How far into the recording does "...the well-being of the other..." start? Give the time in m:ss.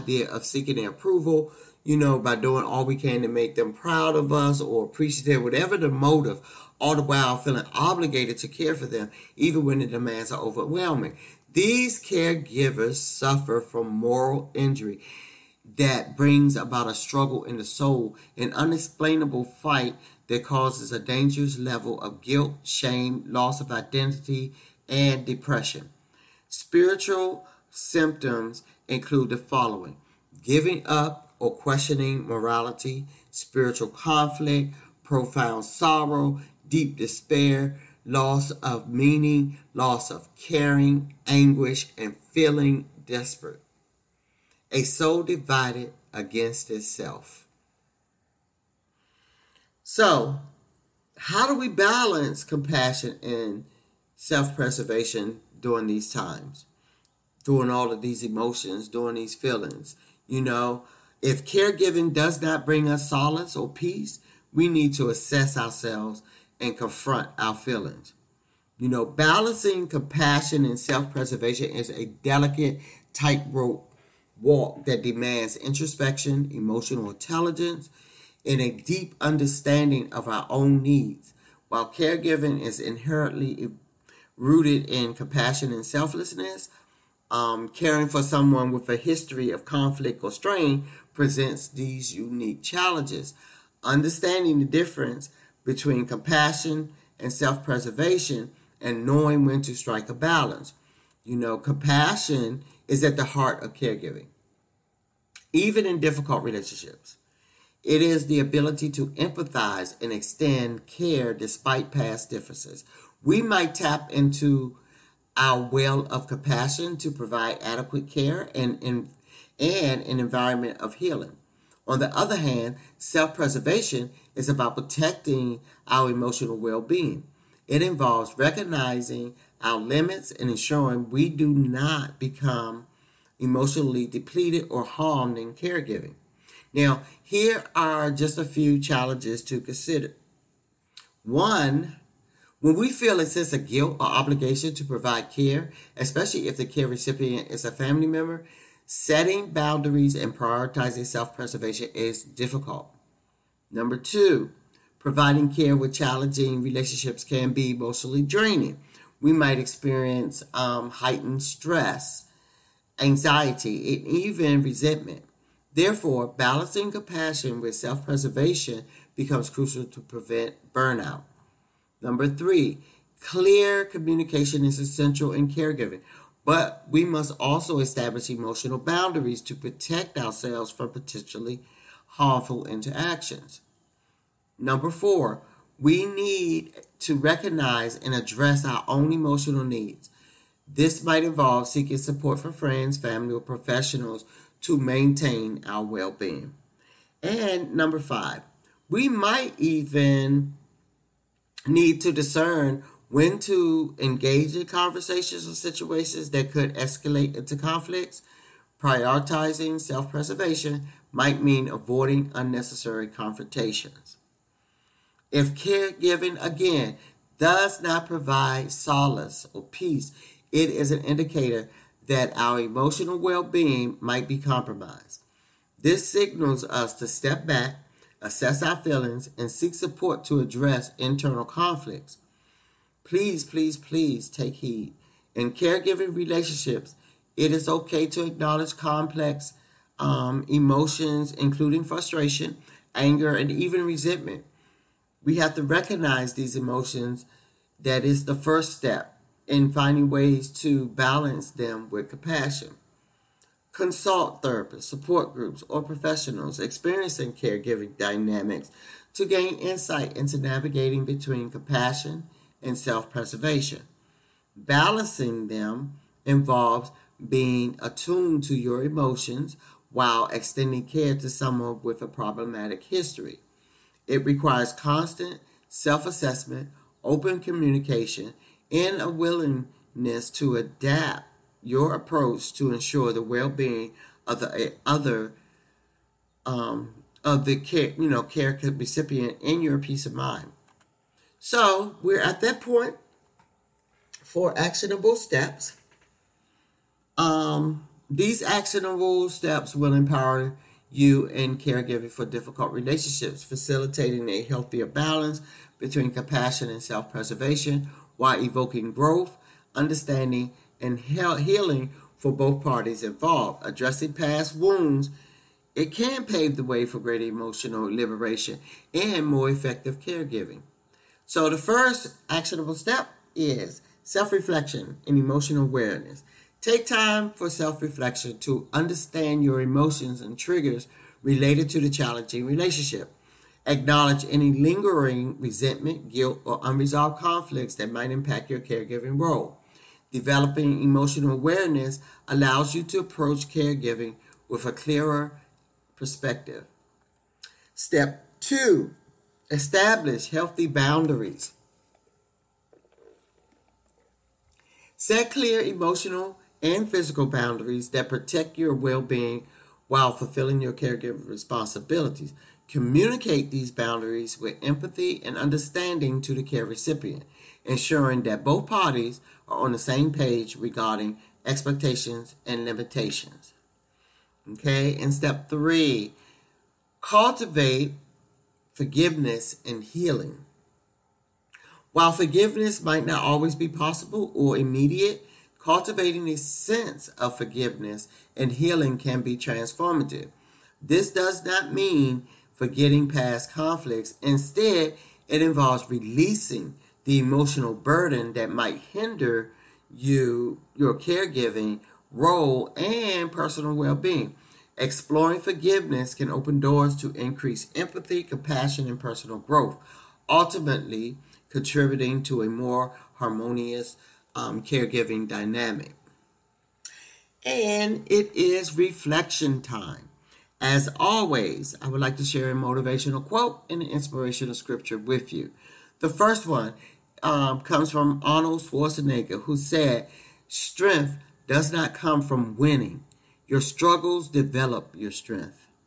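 4:43.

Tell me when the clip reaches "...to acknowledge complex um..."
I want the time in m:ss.
3:58.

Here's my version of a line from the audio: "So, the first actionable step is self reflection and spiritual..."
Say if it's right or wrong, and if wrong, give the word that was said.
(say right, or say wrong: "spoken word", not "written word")
wrong: "emotional", not "spiritual".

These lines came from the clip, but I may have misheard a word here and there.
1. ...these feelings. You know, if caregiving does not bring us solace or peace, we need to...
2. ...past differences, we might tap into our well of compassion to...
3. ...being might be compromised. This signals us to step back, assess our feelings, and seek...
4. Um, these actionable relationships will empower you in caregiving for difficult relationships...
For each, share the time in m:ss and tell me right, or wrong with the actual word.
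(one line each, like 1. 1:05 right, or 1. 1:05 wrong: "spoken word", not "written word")
1. 0:59 right
2. 1:51 right
3. 3:43 right
4. 4:57 wrong: "steps", not "relationships".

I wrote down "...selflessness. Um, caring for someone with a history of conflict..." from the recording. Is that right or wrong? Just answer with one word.
right.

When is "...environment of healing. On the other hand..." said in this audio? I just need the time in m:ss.
2:00.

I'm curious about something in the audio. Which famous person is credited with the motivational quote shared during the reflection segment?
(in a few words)
Arnold Schwarzenegger.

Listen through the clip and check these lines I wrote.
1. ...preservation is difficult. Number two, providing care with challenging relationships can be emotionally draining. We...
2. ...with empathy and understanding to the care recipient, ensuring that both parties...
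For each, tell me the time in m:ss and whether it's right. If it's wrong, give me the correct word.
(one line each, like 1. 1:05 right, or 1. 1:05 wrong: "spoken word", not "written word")
1. 2:31 right
2. 6:04 right.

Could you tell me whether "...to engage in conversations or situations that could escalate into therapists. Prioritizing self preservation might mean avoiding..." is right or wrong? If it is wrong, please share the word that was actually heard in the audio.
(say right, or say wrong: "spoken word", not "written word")
wrong: "conflicts", not "therapists".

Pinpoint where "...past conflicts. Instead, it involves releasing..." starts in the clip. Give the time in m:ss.
6:33.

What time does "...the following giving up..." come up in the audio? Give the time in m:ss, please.
0:29.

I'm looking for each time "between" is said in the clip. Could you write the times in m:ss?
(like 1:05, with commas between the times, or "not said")
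1:35, 4:21, 5:05.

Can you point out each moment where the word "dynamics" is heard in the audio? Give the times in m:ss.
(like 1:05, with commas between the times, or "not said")
4:17, 6:55.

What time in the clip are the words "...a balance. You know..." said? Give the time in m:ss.
1:40.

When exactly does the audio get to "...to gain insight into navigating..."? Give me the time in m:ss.
4:19.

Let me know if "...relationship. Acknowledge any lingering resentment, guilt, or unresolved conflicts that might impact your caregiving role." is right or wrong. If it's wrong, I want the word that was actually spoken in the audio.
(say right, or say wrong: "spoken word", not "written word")
right.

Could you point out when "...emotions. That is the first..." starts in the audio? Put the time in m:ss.
4:06.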